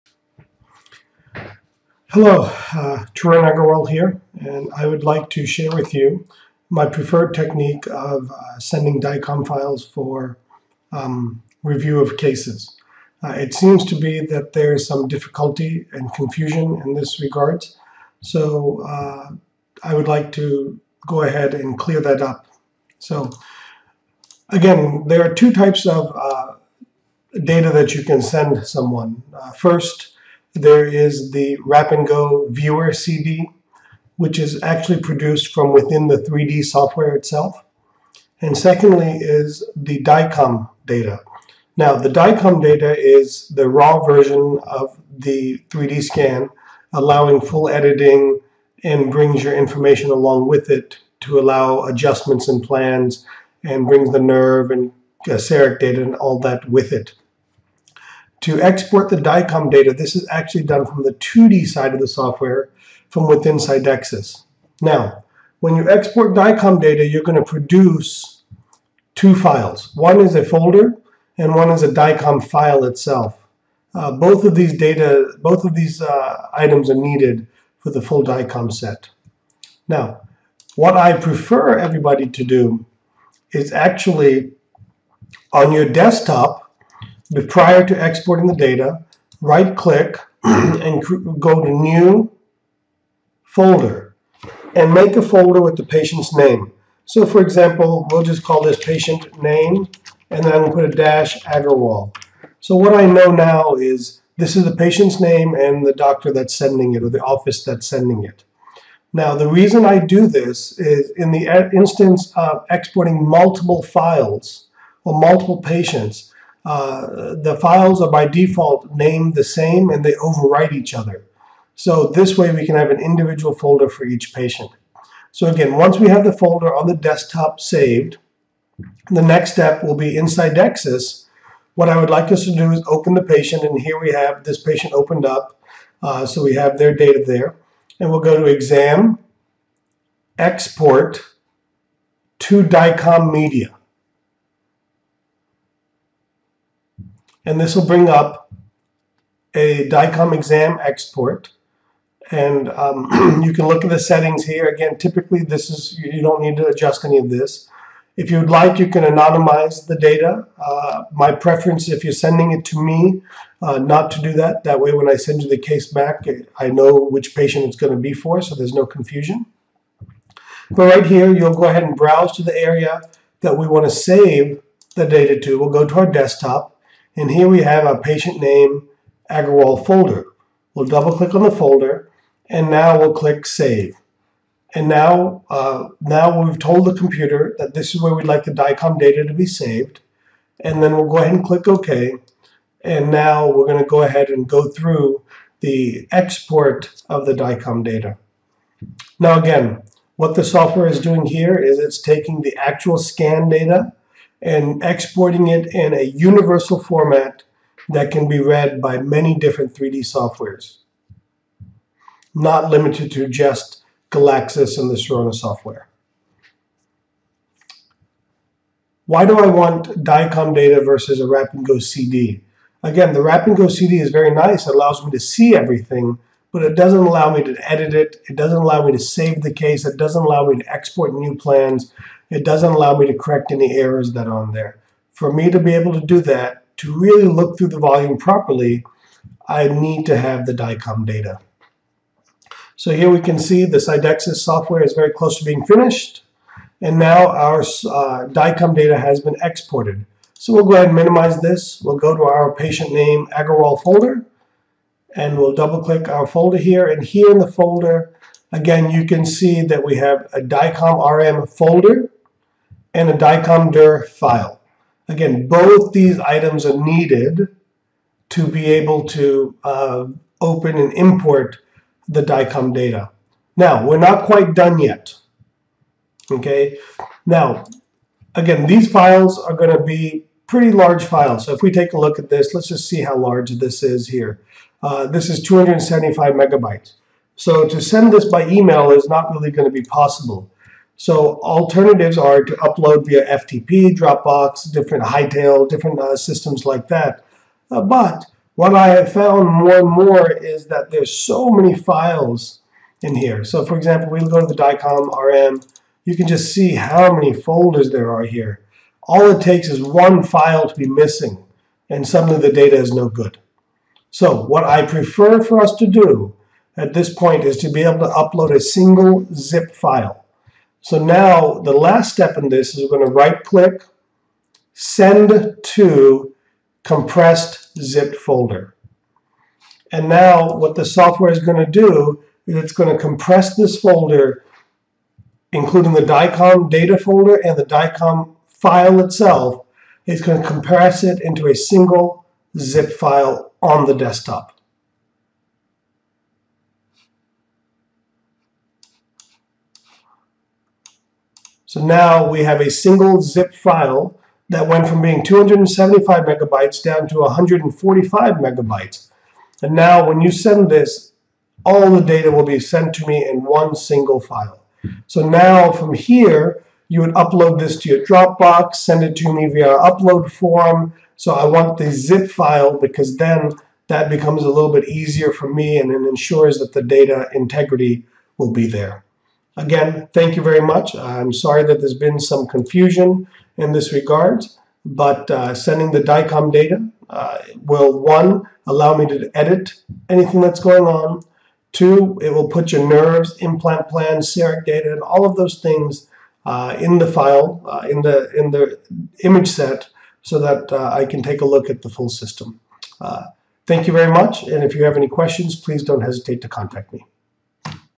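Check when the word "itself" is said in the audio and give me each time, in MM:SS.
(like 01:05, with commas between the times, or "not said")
00:37, 01:12, 05:39.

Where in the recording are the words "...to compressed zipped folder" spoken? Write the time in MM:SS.
05:25.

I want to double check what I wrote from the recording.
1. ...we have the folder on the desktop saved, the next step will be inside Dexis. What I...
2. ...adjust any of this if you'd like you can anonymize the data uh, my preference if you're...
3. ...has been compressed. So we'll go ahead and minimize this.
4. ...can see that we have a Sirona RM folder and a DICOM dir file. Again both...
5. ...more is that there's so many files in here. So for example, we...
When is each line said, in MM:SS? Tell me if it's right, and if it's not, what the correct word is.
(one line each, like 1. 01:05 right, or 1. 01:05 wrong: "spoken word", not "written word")
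1. 02:05 right
2. 02:36 right
3. 04:08 wrong: "exported", not "compressed"
4. 04:19 wrong: "DICOM", not "Sirona"
5. 04:59 right.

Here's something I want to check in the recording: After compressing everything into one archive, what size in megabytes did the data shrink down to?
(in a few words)
145 megabytes.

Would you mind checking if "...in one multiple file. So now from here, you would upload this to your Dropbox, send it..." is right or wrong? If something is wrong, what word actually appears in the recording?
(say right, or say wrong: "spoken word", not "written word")
wrong: "single", not "multiple".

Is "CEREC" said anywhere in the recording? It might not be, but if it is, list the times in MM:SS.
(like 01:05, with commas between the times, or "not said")
00:55, 06:34.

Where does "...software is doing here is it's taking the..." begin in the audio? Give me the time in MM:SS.
03:20.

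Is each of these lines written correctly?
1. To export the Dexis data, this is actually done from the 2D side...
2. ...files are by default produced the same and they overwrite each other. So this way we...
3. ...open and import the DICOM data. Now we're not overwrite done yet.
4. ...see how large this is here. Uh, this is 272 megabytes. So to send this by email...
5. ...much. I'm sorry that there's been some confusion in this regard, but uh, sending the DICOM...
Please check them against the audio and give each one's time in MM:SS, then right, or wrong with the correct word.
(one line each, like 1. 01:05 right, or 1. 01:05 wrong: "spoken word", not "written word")
1. 00:58 wrong: "DICOM", not "Dexis"
2. 01:57 wrong: "named", not "produced"
3. 04:30 wrong: "quite", not "overwrite"
4. 04:42 wrong: "275", not "272"
5. 06:20 right.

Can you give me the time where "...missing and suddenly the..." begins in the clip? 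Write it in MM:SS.
05:10.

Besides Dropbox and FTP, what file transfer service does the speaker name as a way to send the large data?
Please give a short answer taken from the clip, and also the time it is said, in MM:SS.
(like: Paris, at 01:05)
Hightail, at 04:55.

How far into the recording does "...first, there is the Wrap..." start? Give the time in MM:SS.
00:29.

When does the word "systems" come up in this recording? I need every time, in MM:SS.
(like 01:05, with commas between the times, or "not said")
04:56, 06:42.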